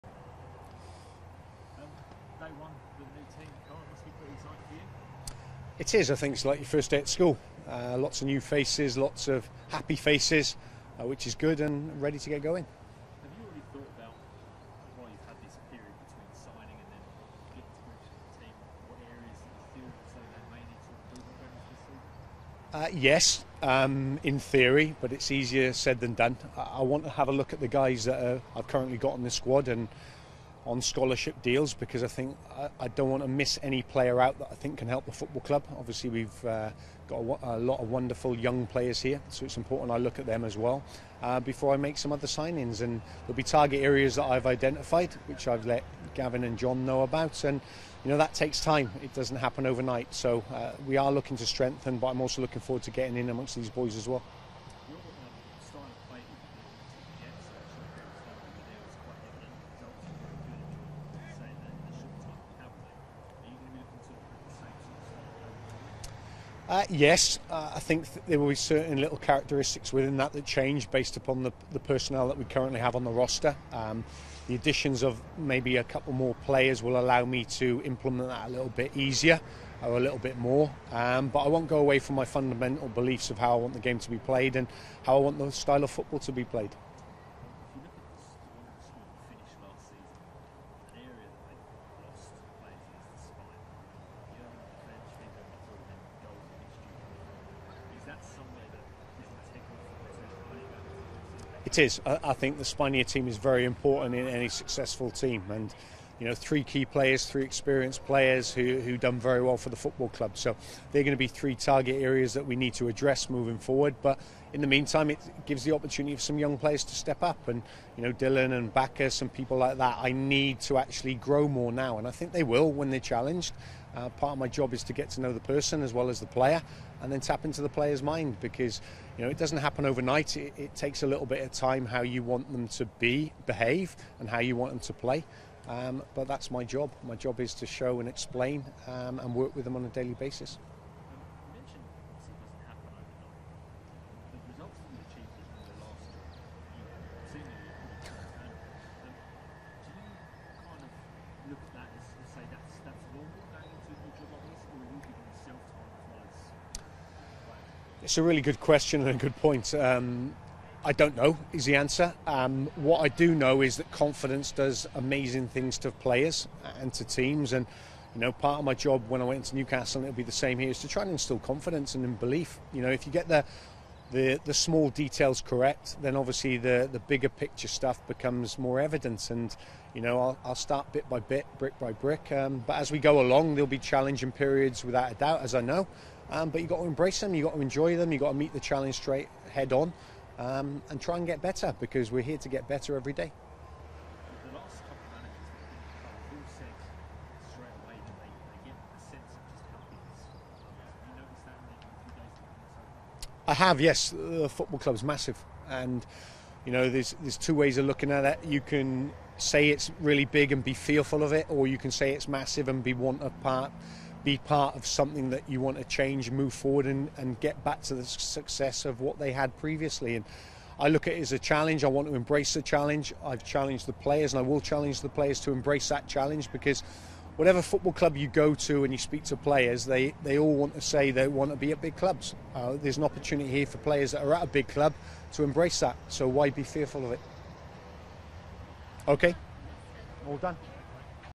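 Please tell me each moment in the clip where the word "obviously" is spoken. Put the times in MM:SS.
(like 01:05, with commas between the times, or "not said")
00:35, 02:56.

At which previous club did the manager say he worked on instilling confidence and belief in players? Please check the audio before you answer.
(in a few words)
Newcastle.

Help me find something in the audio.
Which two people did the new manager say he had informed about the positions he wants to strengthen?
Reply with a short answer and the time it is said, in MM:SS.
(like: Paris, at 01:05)
Gavin and John, at 00:46.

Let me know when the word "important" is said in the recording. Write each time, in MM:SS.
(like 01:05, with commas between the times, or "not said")
00:39, 01:43.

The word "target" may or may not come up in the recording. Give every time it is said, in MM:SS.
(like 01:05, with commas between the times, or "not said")
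00:43, 01:51.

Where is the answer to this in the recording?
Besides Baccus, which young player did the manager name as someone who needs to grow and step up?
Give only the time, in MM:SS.
01:58.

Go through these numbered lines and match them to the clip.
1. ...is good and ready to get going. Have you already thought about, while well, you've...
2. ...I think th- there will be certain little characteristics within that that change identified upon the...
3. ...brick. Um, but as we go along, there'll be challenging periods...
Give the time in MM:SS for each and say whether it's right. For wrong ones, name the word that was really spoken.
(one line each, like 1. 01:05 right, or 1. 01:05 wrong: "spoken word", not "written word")
1. 00:11 right
2. 01:07 wrong: "based", not "identified"
3. 03:01 right.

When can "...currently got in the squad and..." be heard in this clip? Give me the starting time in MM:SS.
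00:28.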